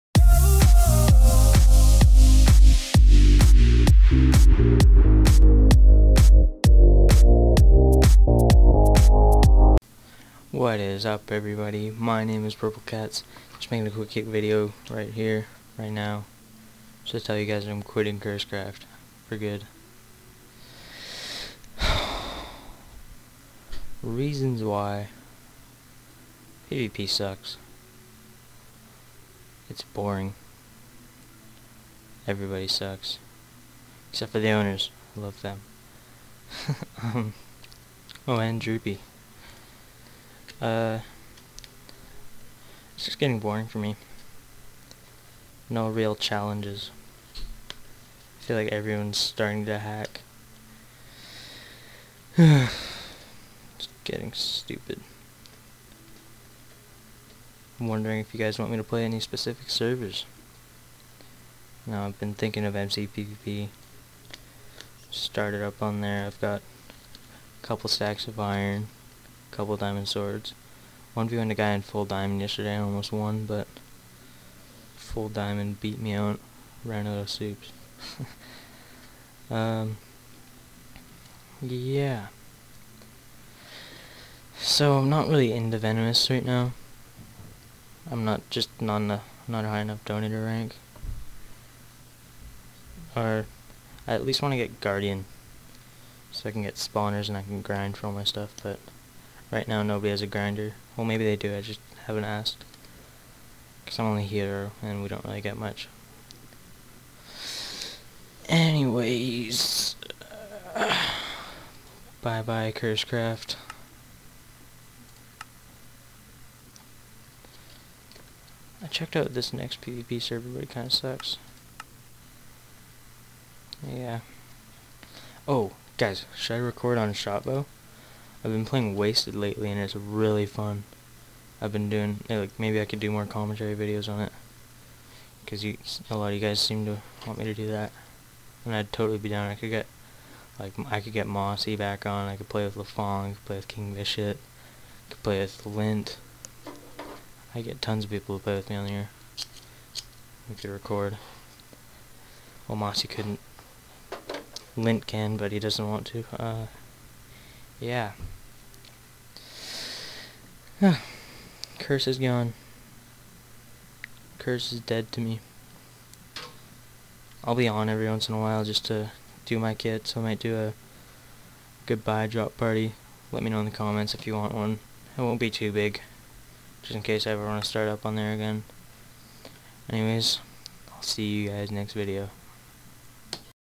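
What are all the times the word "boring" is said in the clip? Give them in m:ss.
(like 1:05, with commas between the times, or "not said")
0:29, 0:43.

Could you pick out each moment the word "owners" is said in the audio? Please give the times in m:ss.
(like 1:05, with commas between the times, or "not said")
0:34.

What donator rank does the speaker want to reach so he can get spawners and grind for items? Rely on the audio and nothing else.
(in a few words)
guardian.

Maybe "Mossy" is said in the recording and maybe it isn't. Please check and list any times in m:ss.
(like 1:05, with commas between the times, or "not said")
2:21, 2:32.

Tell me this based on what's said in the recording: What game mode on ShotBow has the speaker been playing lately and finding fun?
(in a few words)
Wasted.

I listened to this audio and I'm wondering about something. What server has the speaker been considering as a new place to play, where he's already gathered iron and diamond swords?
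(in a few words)
MCPVP.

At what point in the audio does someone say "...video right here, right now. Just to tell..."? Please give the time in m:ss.
0:14.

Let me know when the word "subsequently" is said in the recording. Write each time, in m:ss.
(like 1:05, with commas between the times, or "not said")
not said.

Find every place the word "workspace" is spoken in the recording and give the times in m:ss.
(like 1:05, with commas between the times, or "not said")
not said.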